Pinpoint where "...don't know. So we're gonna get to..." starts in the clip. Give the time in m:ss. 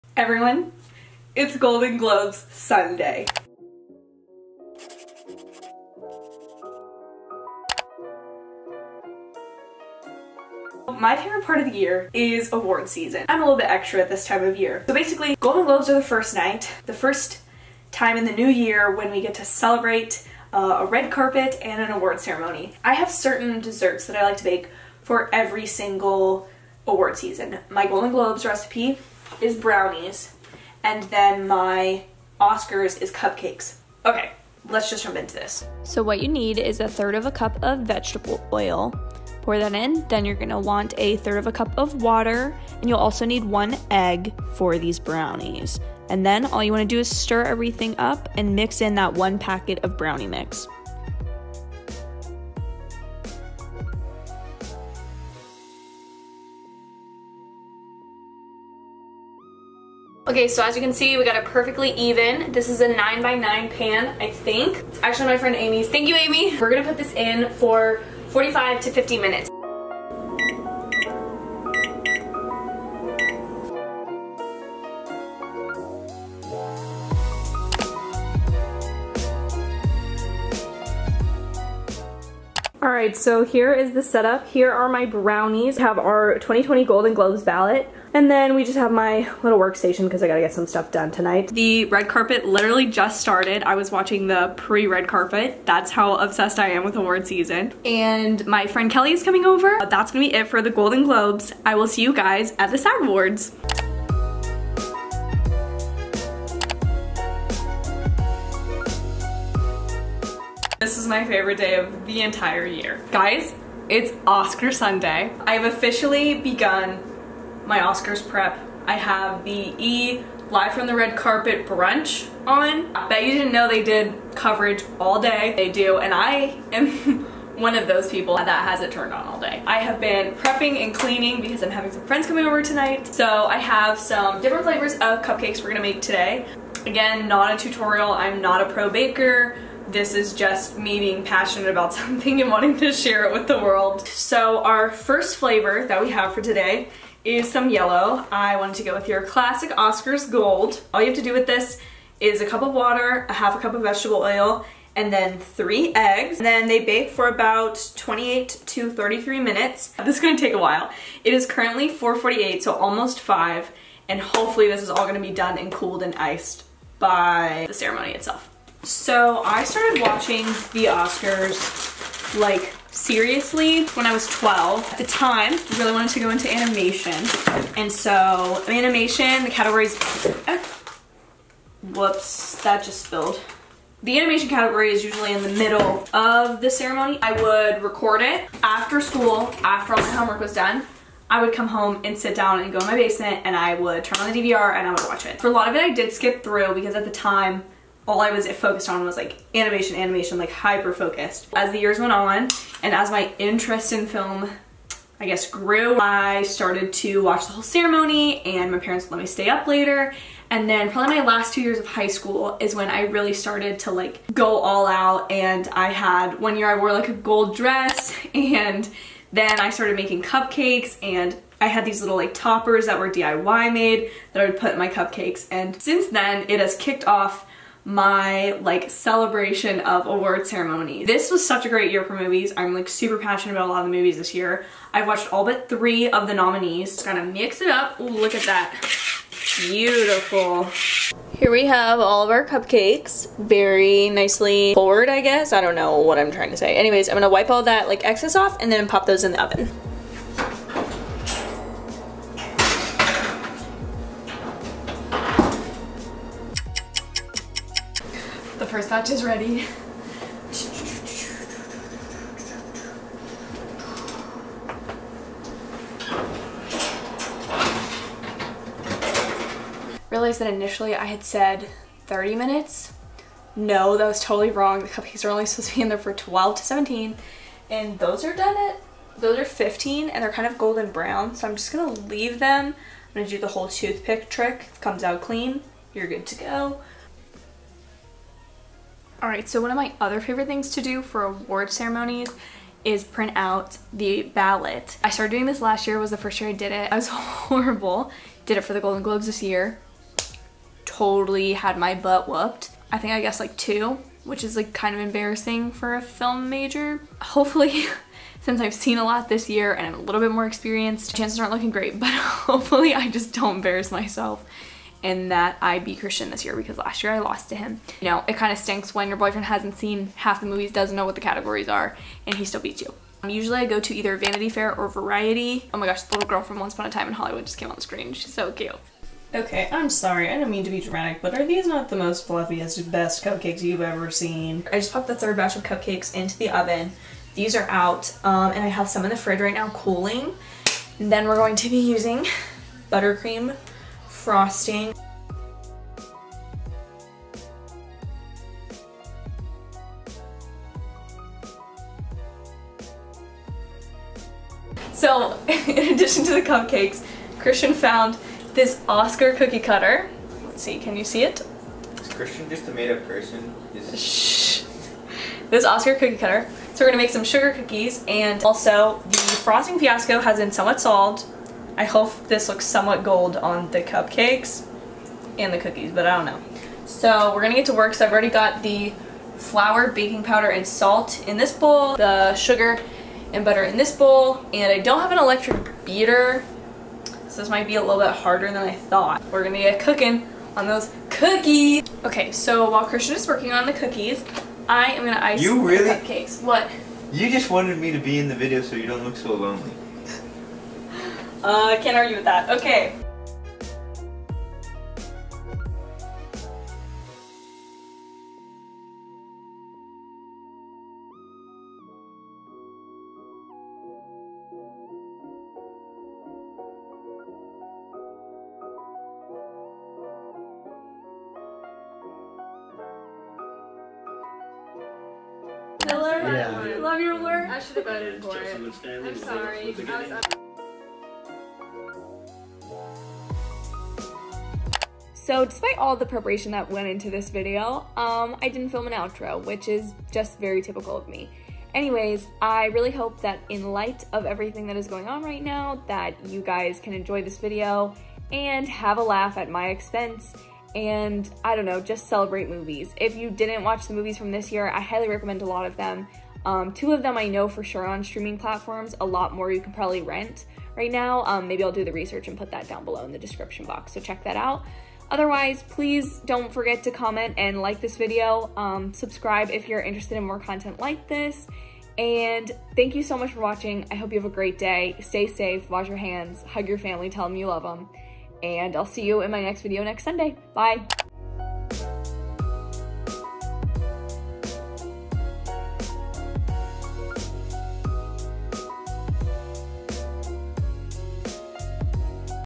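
6:16.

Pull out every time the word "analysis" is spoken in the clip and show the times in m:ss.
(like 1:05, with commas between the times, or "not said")
not said.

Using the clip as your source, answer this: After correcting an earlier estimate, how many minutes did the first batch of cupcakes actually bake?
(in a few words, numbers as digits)
15.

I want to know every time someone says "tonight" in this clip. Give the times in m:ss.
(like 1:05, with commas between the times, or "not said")
1:31, 2:12.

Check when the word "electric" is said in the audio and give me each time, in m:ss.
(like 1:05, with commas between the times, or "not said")
6:25.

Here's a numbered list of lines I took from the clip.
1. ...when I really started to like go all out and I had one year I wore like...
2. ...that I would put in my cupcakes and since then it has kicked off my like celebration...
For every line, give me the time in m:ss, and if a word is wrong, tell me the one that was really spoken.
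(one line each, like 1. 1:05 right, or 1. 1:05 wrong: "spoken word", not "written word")
1. 3:32 right
2. 3:44 right.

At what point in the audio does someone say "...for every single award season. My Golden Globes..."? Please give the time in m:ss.
0:25.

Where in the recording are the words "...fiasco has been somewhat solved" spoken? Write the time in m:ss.
6:09.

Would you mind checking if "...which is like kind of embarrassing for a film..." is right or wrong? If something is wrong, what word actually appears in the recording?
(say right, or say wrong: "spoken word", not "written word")
right.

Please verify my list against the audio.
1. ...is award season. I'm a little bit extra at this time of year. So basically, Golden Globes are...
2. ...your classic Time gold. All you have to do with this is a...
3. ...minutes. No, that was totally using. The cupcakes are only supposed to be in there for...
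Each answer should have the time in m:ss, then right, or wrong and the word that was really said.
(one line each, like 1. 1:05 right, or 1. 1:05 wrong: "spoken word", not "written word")
1. 0:12 right
2. 2:29 wrong: "Oscars", not "Time"
3. 4:32 wrong: "wrong", not "using".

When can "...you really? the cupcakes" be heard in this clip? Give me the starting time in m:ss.
6:35.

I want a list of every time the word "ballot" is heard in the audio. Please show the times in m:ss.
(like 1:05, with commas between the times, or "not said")
1:27, 4:54.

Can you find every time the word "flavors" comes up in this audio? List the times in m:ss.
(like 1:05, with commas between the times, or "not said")
2:14, 2:25.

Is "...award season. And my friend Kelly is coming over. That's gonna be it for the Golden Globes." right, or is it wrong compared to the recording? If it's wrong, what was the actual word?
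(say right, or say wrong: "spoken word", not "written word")
right.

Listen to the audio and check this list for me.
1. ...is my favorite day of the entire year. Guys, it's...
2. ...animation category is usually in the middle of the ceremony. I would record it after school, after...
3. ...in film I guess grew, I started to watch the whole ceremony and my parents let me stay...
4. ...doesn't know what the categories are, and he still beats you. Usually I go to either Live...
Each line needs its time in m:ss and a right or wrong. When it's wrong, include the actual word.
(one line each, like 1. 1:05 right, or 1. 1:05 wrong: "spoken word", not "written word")
1. 1:50 right
2. 3:04 right
3. 3:23 right
4. 5:20 wrong: "Vanity", not "Live".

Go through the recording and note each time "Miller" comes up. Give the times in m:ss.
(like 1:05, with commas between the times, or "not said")
7:05.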